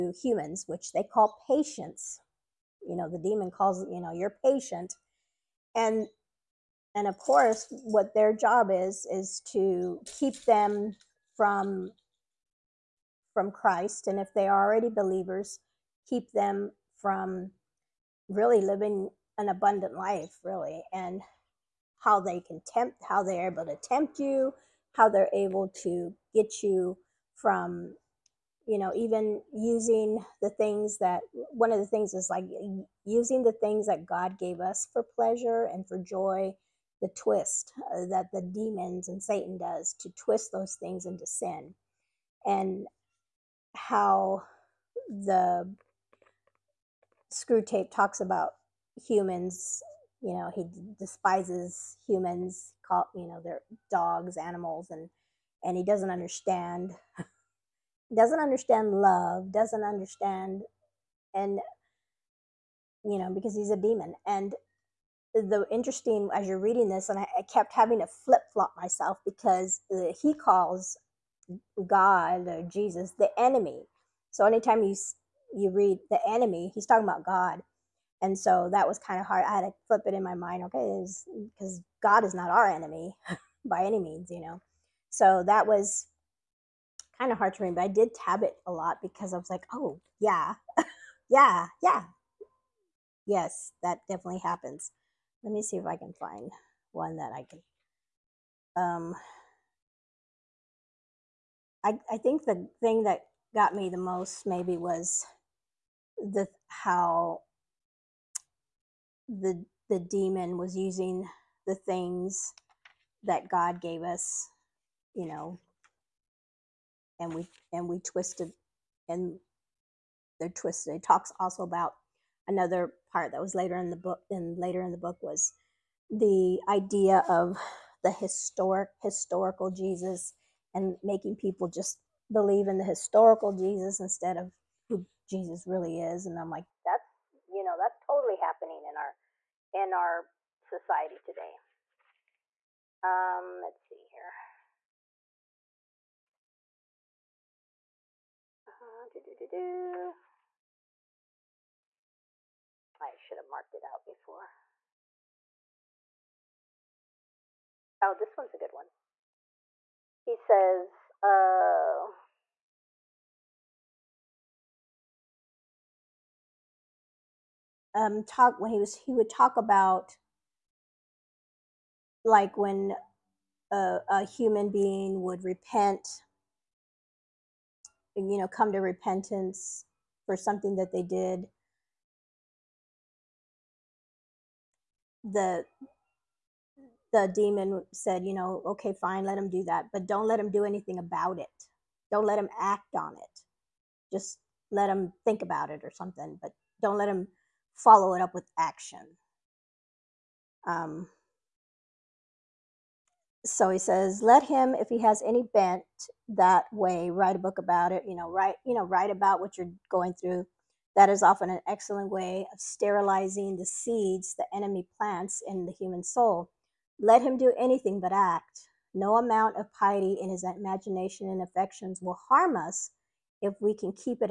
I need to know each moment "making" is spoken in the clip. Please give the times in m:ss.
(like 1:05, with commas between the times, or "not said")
2:11.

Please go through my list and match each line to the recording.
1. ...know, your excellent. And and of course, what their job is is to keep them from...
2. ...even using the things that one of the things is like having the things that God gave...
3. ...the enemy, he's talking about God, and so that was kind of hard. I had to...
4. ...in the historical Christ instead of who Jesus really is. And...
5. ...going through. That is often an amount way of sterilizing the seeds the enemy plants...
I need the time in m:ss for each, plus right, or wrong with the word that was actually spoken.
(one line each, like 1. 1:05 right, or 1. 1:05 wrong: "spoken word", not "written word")
1. 0:04 wrong: "patient", not "excellent"
2. 0:28 wrong: "using", not "having"
3. 1:16 right
4. 2:12 wrong: "Jesus", not "Christ"
5. 3:29 wrong: "excellent", not "amount".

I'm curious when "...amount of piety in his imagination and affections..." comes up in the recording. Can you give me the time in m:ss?
3:39.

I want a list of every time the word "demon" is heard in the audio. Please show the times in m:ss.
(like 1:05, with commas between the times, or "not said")
0:03, 0:38, 1:03, 1:50, 3:07.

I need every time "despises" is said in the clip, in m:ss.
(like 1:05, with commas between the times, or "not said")
0:50.